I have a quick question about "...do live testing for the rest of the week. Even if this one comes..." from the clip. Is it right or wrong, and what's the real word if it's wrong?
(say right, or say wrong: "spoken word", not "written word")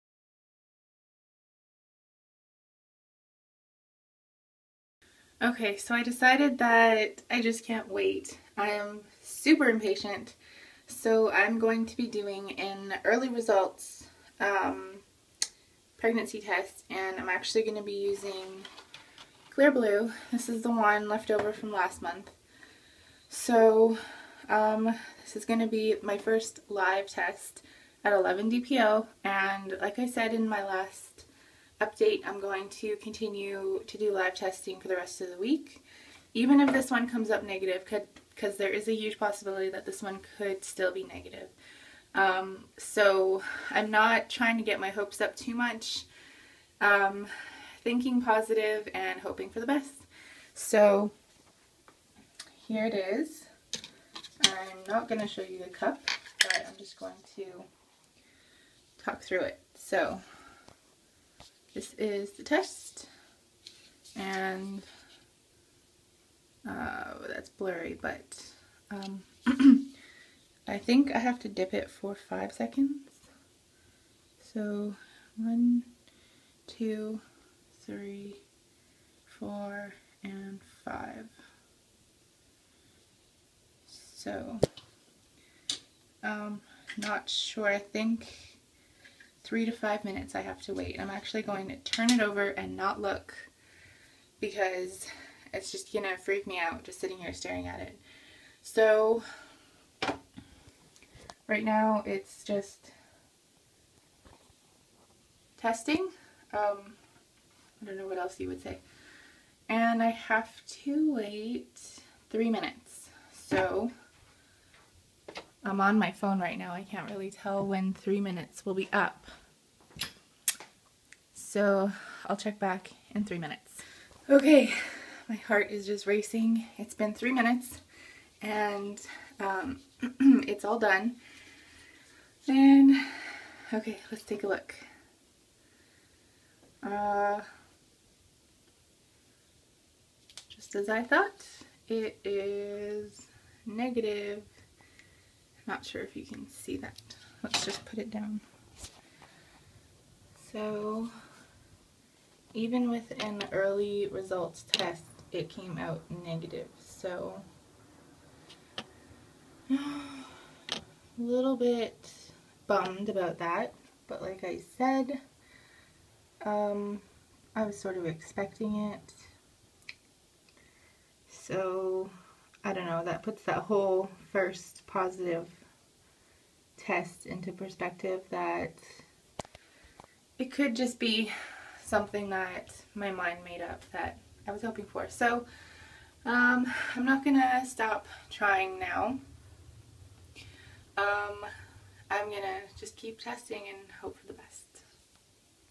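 right.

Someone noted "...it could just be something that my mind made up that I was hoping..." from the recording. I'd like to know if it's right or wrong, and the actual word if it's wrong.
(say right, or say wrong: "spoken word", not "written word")
right.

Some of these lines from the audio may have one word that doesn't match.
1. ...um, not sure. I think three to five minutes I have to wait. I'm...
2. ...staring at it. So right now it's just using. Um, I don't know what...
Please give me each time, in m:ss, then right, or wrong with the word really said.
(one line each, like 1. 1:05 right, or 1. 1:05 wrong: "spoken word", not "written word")
1. 1:26 right
2. 1:37 wrong: "testing", not "using".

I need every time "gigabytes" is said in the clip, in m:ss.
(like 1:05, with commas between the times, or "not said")
not said.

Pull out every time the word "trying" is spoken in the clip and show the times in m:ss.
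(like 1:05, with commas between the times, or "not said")
0:44, 3:08.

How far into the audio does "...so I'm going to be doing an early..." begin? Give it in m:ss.
0:10.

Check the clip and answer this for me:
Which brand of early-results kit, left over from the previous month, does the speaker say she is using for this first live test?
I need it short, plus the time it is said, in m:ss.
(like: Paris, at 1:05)
Clearblue, at 0:19.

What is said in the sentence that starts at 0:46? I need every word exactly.
Um, thinking positive and hoping for the best.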